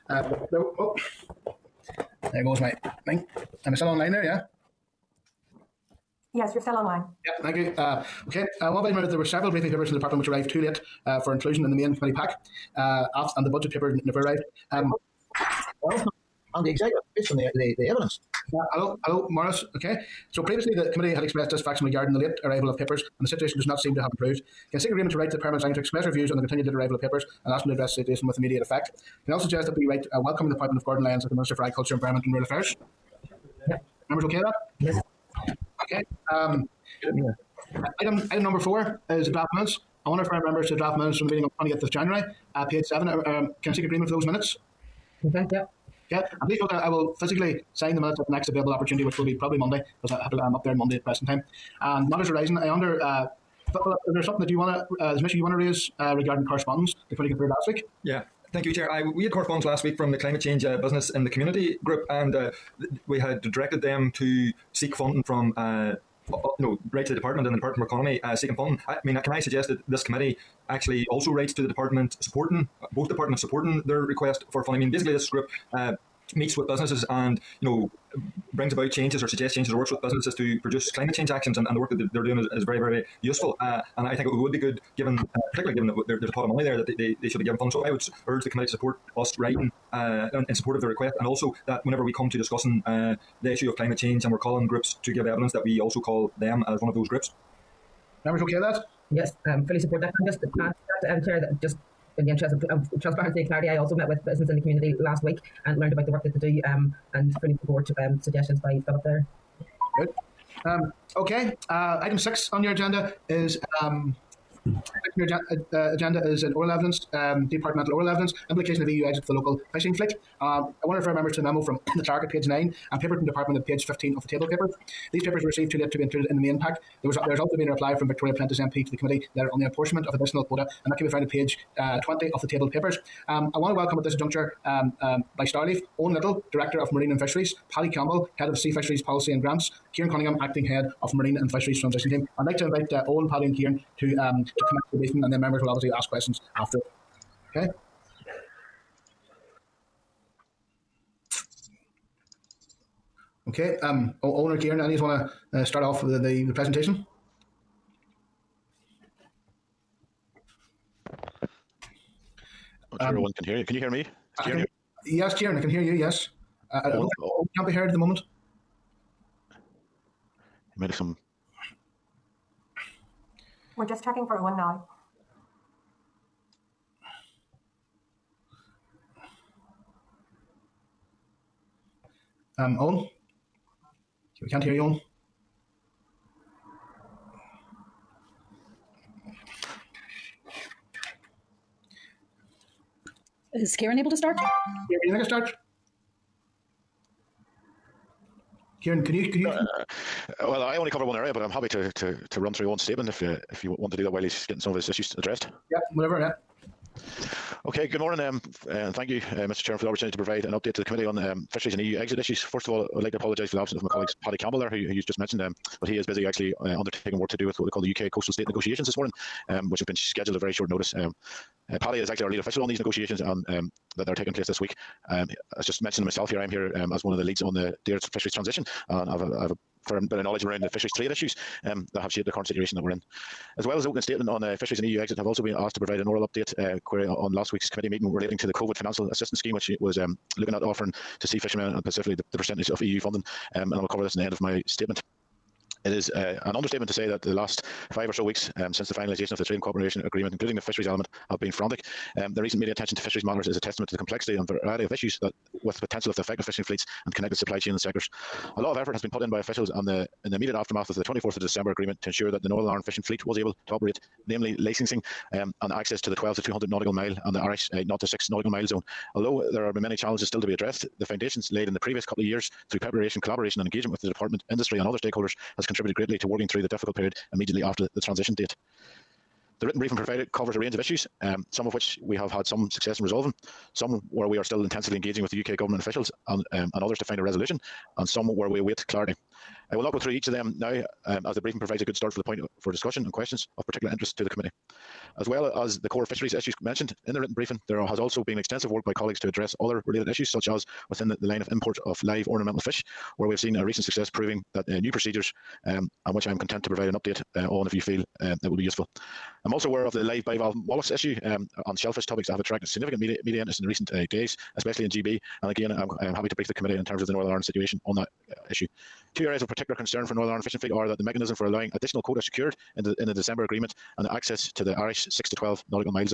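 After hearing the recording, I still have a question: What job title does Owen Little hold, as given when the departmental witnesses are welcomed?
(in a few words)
Director of Marine and Fisheries.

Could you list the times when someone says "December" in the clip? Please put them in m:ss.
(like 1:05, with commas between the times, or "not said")
4:21, 5:23.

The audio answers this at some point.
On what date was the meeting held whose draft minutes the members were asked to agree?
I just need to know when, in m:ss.
0:41.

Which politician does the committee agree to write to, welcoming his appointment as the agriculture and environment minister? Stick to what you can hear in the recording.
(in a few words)
Gordon Lyons.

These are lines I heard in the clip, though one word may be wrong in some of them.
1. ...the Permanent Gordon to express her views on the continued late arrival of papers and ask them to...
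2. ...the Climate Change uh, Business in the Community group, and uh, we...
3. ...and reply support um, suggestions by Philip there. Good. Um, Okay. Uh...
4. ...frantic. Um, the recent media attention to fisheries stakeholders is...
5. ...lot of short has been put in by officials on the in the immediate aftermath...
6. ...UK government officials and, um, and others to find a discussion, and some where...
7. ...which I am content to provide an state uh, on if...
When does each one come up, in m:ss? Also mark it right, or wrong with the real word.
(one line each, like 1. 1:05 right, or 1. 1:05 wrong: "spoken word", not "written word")
1. 0:25 wrong: "Secretary", not "Gordon"
2. 1:00 right
3. 1:47 wrong: "fully", not "reply"
4. 4:11 wrong: "matters", not "stakeholders"
5. 4:18 wrong: "effort", not "short"
6. 4:45 wrong: "resolution", not "discussion"
7. 5:06 wrong: "update", not "state".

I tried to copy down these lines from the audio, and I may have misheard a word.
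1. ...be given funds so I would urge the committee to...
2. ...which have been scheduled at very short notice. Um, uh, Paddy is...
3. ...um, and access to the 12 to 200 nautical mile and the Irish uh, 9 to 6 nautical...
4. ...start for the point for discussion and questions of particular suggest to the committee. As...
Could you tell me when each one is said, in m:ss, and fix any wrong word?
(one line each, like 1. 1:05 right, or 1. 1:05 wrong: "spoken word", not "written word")
1. 1:27 right
2. 3:39 right
3. 4:25 wrong: "0", not "9"
4. 4:51 wrong: "interest", not "suggest".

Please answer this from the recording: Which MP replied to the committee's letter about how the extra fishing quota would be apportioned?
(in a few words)
Victoria Prentice.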